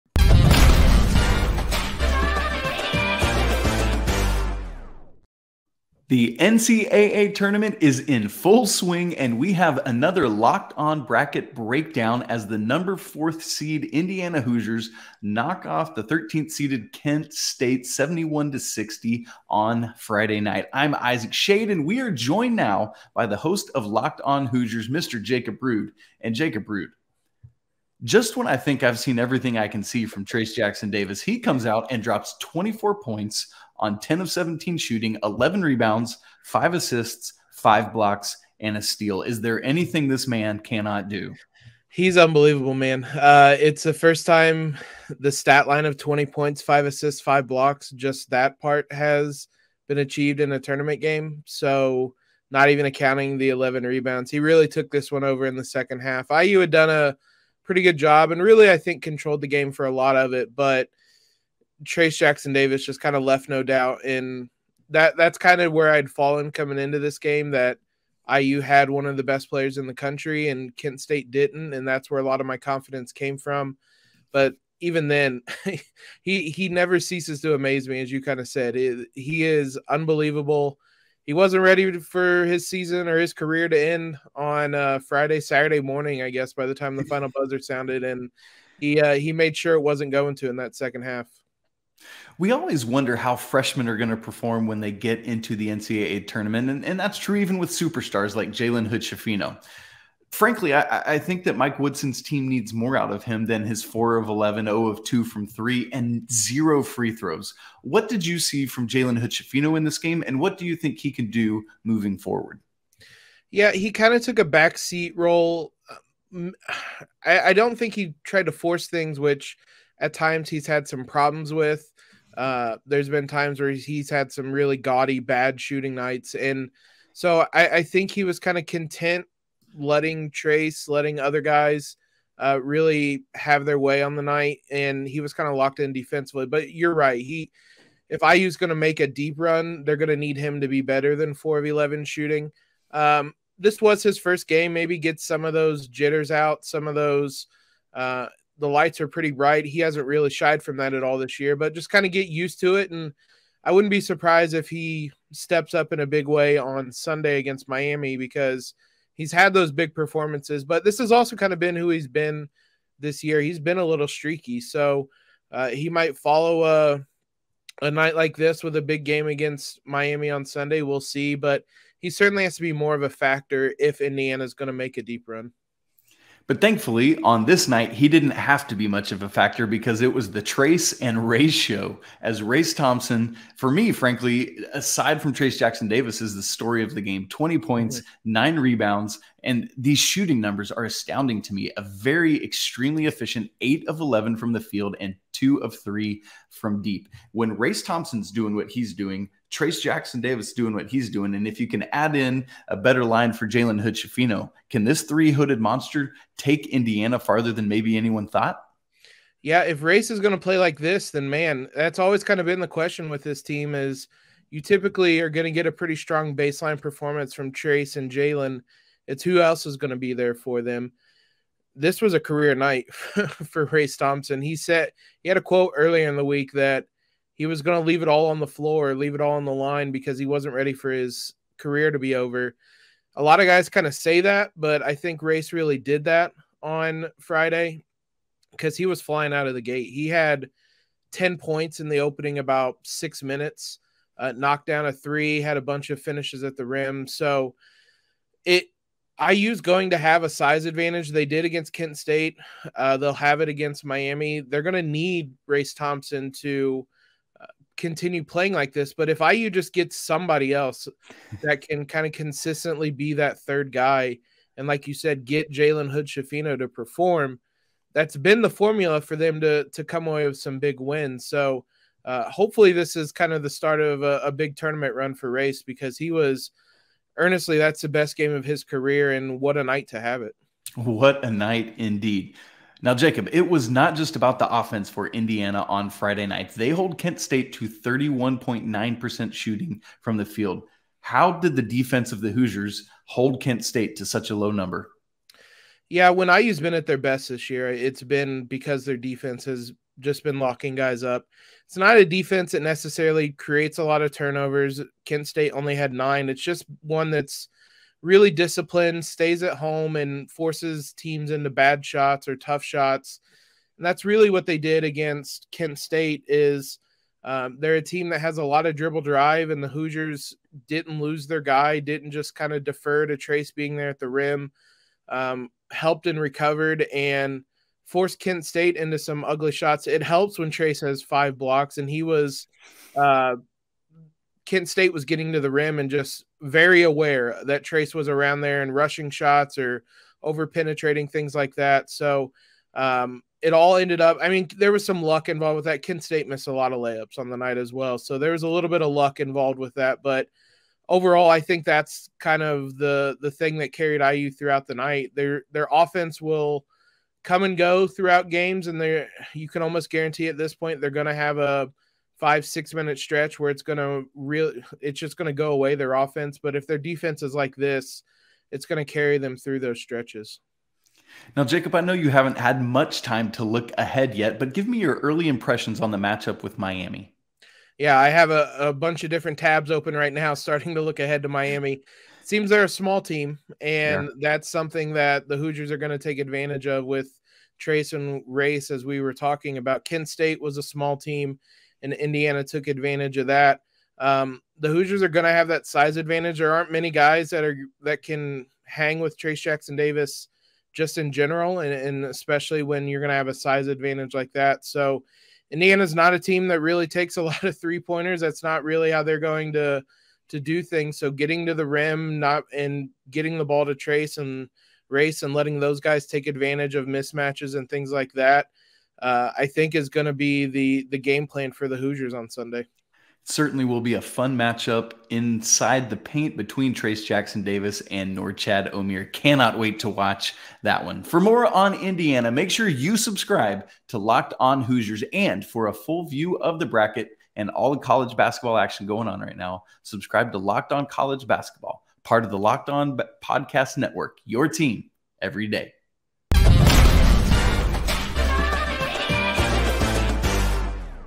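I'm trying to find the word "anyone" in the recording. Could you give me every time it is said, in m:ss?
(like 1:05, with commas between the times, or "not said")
3:27.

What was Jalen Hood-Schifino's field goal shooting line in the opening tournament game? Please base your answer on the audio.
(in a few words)
4 of 11.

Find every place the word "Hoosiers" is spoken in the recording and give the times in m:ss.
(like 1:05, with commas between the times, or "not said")
0:14, 0:24, 4:52, 5:19, 6:25, 6:34, 7:01, 7:14.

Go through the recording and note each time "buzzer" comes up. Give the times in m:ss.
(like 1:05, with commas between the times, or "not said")
1:27.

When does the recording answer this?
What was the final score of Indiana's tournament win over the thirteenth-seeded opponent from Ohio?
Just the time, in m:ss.
0:17.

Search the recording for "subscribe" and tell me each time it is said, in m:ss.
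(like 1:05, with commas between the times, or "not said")
7:12, 7:19.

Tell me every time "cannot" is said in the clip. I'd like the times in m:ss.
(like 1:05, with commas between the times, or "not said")
0:40, 7:09.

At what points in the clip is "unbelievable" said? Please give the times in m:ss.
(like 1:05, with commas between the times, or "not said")
0:42, 1:19.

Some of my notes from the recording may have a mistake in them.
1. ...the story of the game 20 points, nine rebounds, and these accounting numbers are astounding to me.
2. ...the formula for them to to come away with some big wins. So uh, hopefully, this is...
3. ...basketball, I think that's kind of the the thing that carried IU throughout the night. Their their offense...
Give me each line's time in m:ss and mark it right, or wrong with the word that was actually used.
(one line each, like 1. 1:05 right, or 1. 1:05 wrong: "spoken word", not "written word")
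1. 3:06 wrong: "shooting", not "accounting"
2. 4:28 right
3. 5:50 wrong: "overall", not "basketball".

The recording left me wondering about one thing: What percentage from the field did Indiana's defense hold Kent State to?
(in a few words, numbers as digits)
31.9%.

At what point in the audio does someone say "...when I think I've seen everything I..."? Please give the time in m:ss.
0:28.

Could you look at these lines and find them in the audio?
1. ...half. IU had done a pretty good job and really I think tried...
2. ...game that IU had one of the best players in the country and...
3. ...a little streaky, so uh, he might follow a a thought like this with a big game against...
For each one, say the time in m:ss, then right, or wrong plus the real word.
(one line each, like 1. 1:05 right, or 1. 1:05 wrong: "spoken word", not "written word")
1. 0:55 wrong: "controlled", not "tried"
2. 1:07 right
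3. 2:43 wrong: "night", not "thought".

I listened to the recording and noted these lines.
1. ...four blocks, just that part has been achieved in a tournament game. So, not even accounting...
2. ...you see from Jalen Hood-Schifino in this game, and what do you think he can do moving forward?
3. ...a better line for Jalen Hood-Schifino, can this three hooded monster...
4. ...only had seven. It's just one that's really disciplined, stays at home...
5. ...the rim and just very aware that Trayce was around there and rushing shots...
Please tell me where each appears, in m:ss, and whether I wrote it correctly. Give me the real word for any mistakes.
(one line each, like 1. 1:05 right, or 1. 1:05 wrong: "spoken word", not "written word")
1. 0:47 wrong: "five", not "four"
2. 1:48 right
3. 3:22 right
4. 5:05 wrong: "nine", not "seven"
5. 5:35 right.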